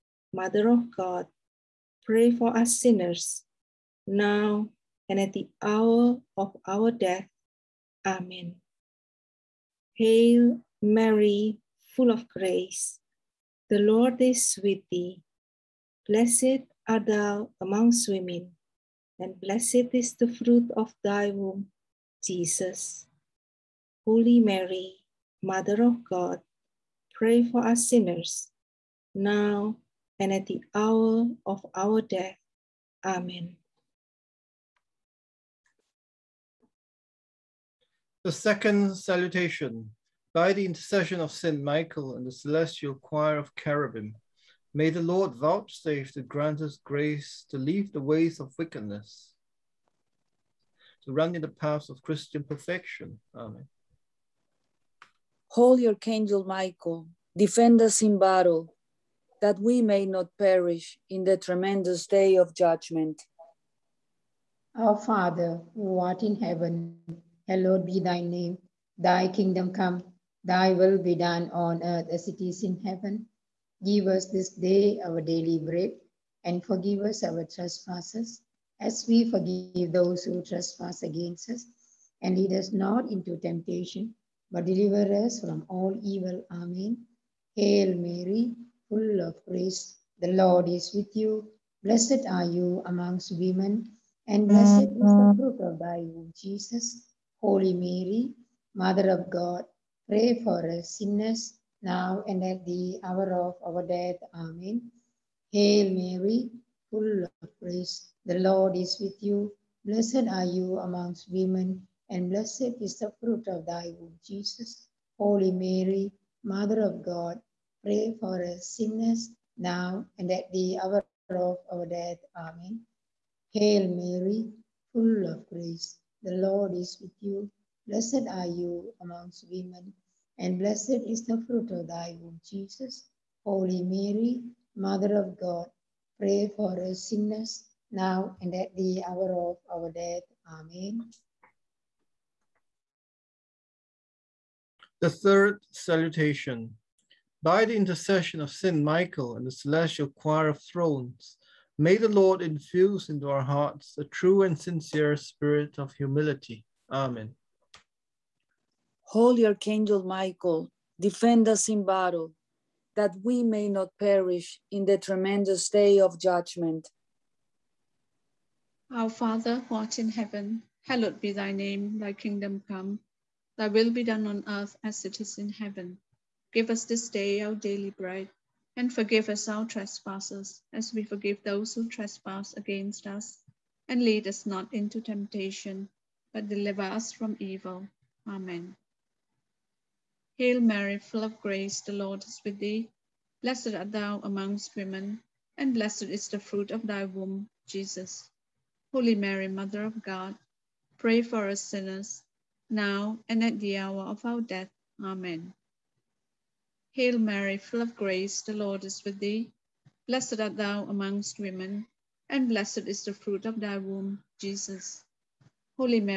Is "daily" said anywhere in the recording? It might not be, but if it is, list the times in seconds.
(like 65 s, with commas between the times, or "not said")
75 s, 177 s.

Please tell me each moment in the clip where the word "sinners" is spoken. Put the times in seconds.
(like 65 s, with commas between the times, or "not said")
2 s, 27 s, 100 s, 118 s, 137 s, 201 s.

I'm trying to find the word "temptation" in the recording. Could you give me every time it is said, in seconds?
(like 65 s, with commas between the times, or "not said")
83 s, 185 s.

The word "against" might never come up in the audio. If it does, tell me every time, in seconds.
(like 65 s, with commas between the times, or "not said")
81 s, 182 s.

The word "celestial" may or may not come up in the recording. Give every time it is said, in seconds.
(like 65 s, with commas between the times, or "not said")
42 s, 149 s.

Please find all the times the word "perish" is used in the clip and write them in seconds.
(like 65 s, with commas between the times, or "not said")
60 s, 163 s.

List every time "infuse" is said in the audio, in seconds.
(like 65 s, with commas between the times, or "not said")
152 s.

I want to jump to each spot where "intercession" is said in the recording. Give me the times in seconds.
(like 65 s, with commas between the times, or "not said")
40 s, 147 s.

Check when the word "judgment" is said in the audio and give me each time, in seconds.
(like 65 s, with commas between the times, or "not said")
62 s, 166 s.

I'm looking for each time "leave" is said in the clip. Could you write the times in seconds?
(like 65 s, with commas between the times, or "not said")
47 s.